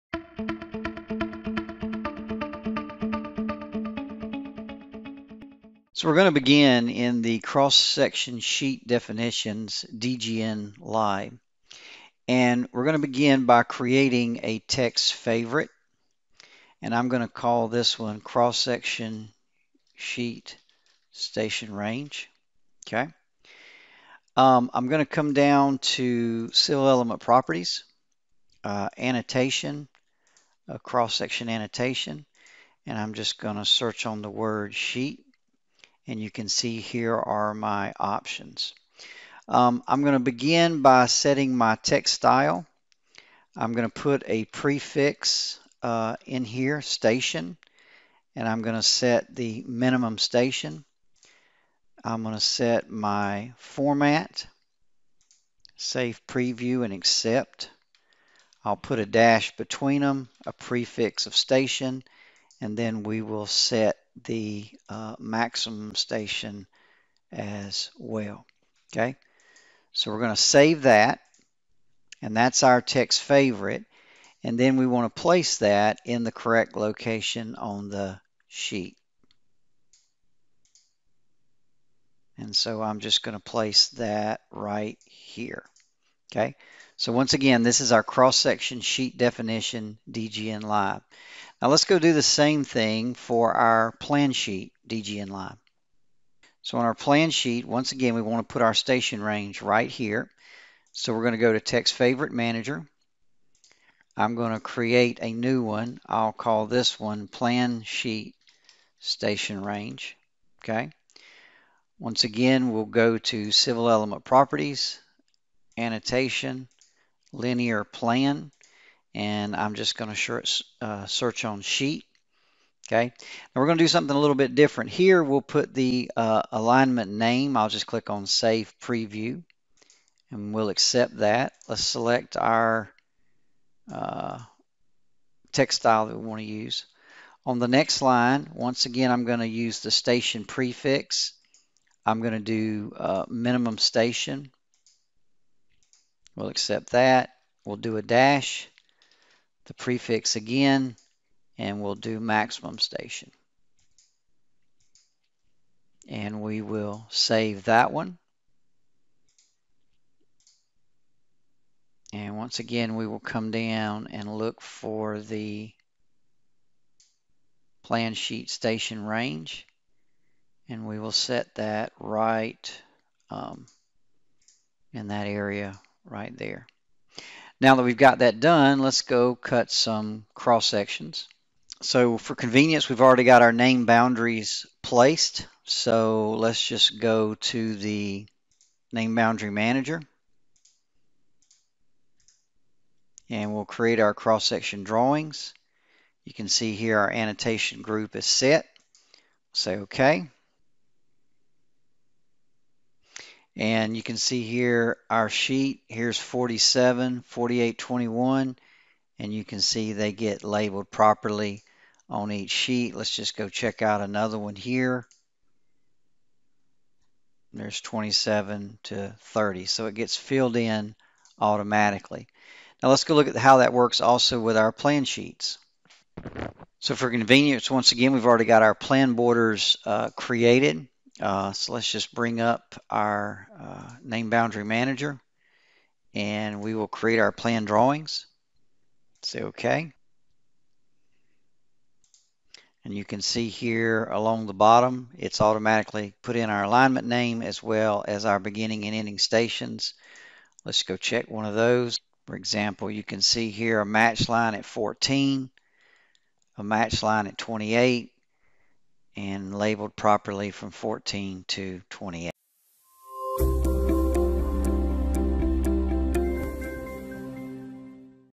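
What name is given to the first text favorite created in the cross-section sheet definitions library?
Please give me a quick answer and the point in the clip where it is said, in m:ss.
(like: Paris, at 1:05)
Cross-section sheet station range, at 0:18.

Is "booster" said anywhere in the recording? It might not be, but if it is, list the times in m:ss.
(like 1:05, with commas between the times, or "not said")
not said.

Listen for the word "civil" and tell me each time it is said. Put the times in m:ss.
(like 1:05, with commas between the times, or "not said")
0:26, 1:53.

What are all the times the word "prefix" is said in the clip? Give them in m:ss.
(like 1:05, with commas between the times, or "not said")
0:44, 1:00, 2:20, 2:29.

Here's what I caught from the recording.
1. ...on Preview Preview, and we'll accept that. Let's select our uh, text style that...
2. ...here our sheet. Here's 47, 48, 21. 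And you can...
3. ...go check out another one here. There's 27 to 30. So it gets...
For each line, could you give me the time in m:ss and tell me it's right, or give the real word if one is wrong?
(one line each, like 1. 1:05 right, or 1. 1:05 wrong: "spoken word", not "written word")
1. 2:08 wrong: "Save", not "Preview"
2. 3:24 right
3. 3:33 right.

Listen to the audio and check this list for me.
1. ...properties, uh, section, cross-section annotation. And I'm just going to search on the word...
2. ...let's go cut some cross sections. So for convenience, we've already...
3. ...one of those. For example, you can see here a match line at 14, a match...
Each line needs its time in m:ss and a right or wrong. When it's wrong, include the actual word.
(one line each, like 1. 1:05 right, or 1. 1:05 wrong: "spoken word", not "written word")
1. 0:27 wrong: "annotation", not "section"
2. 2:58 right
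3. 4:11 right.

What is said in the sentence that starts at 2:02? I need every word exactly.
Okay, now we're going to do something a little bit different.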